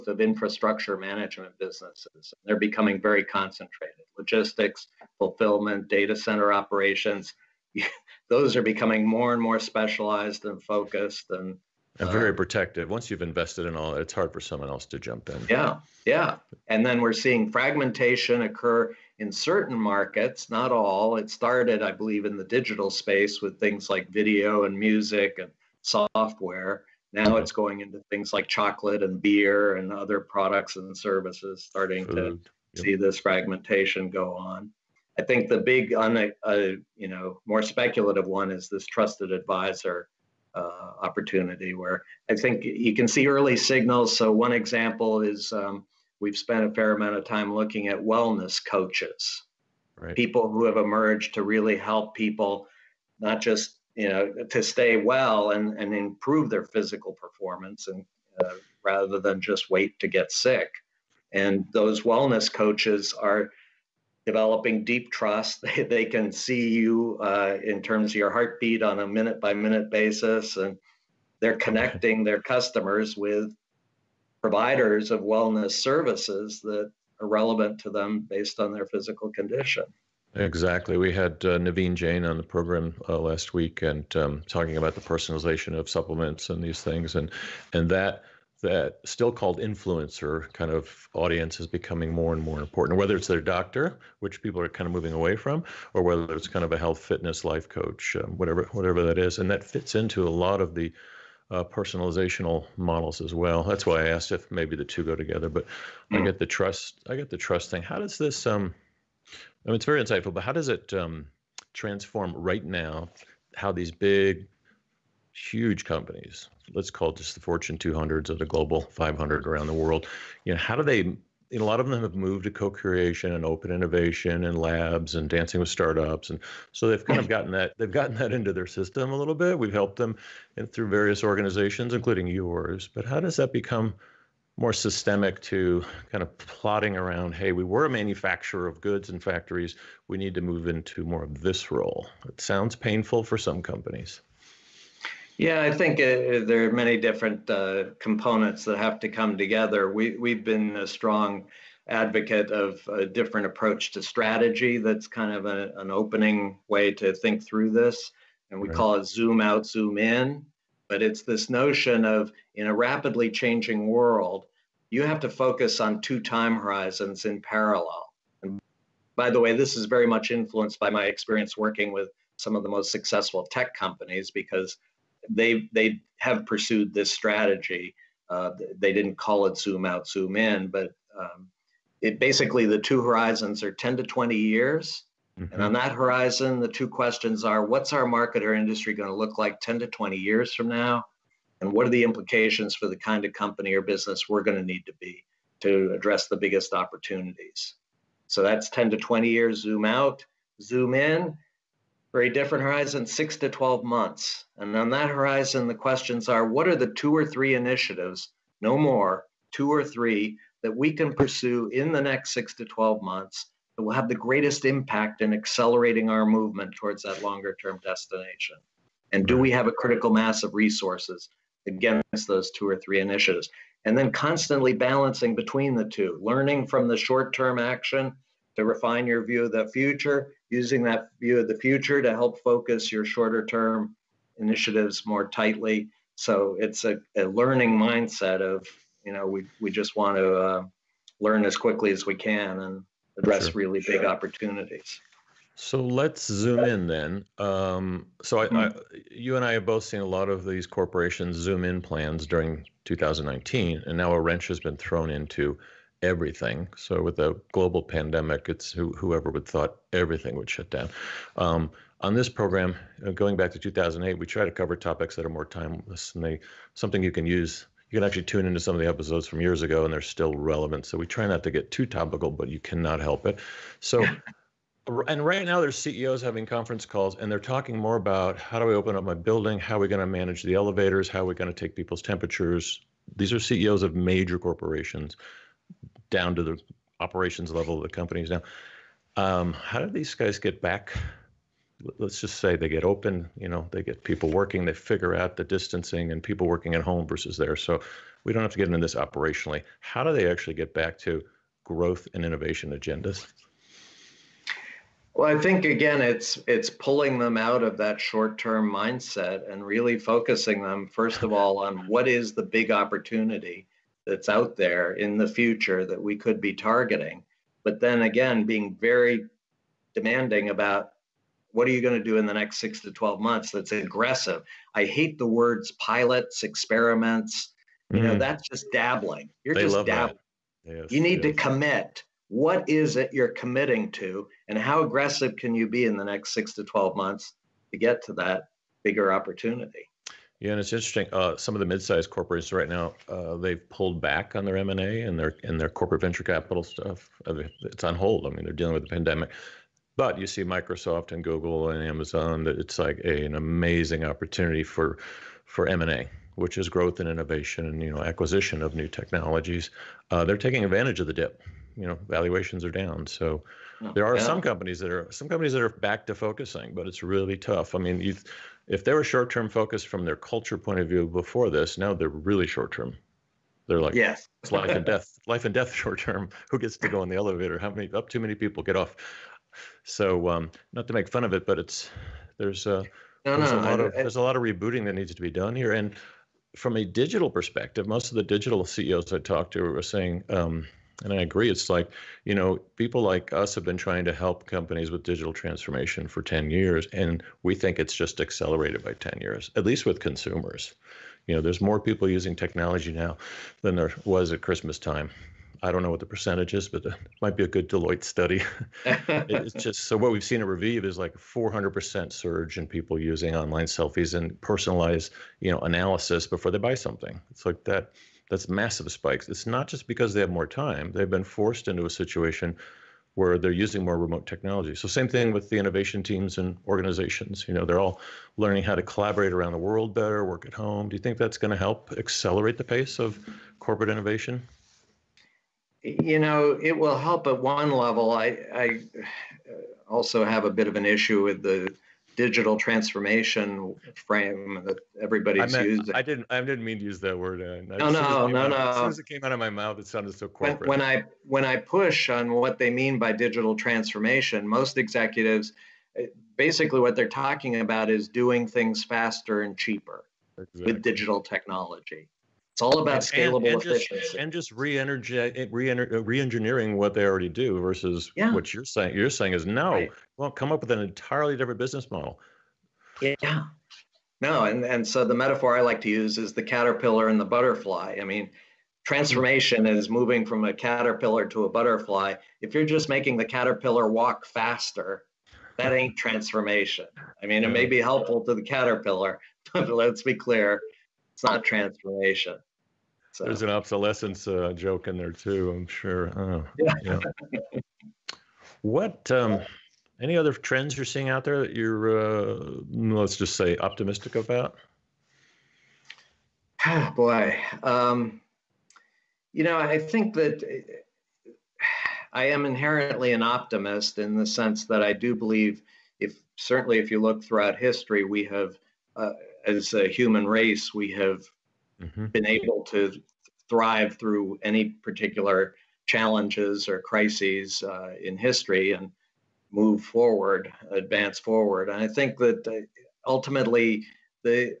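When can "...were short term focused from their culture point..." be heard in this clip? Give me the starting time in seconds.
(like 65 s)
368 s.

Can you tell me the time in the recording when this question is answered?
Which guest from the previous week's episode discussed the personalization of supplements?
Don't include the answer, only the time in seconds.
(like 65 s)
81 s.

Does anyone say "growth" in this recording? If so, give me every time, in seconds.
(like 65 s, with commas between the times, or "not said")
301 s, 356 s.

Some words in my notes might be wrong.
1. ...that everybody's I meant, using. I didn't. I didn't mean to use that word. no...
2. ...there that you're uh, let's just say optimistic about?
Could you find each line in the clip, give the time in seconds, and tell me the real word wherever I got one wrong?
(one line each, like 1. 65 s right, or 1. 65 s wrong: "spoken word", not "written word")
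1. 444 s right
2. 501 s right.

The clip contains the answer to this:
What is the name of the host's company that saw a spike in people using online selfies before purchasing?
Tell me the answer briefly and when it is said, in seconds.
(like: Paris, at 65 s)
Revieve, at 410 s.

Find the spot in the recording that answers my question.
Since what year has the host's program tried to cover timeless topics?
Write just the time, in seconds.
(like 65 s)
263 s.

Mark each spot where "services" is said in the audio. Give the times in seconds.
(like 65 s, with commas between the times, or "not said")
30 s, 75 s.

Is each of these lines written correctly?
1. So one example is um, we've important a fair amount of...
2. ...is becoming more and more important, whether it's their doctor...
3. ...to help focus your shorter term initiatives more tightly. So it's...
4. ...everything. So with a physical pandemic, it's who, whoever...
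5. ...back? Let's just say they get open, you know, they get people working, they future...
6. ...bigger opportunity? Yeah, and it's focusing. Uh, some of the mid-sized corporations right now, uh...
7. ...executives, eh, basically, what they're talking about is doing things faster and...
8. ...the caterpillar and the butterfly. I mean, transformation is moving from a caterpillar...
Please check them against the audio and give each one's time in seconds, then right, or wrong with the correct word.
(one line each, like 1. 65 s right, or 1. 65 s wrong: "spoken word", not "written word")
1. 44 s wrong: "spent", not "important"
2. 91 s right
3. 232 s right
4. 256 s wrong: "global", not "physical"
5. 290 s wrong: "figure", not "future"
6. 338 s wrong: "interesting", not "focusing"
7. 454 s right
8. 476 s right.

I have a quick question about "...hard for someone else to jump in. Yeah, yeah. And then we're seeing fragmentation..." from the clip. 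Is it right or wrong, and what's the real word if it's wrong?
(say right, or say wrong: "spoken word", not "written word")
right.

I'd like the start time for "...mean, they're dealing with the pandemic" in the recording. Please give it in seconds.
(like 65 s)
348 s.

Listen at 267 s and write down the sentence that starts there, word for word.
You can actually tune into some of the episodes from years ago, and they're still relevant.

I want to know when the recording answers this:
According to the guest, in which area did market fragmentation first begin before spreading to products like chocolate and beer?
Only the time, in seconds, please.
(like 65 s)
22 s.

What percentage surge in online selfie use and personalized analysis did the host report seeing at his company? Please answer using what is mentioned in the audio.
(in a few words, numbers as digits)
400%.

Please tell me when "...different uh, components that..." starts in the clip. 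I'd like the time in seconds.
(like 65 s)
146 s.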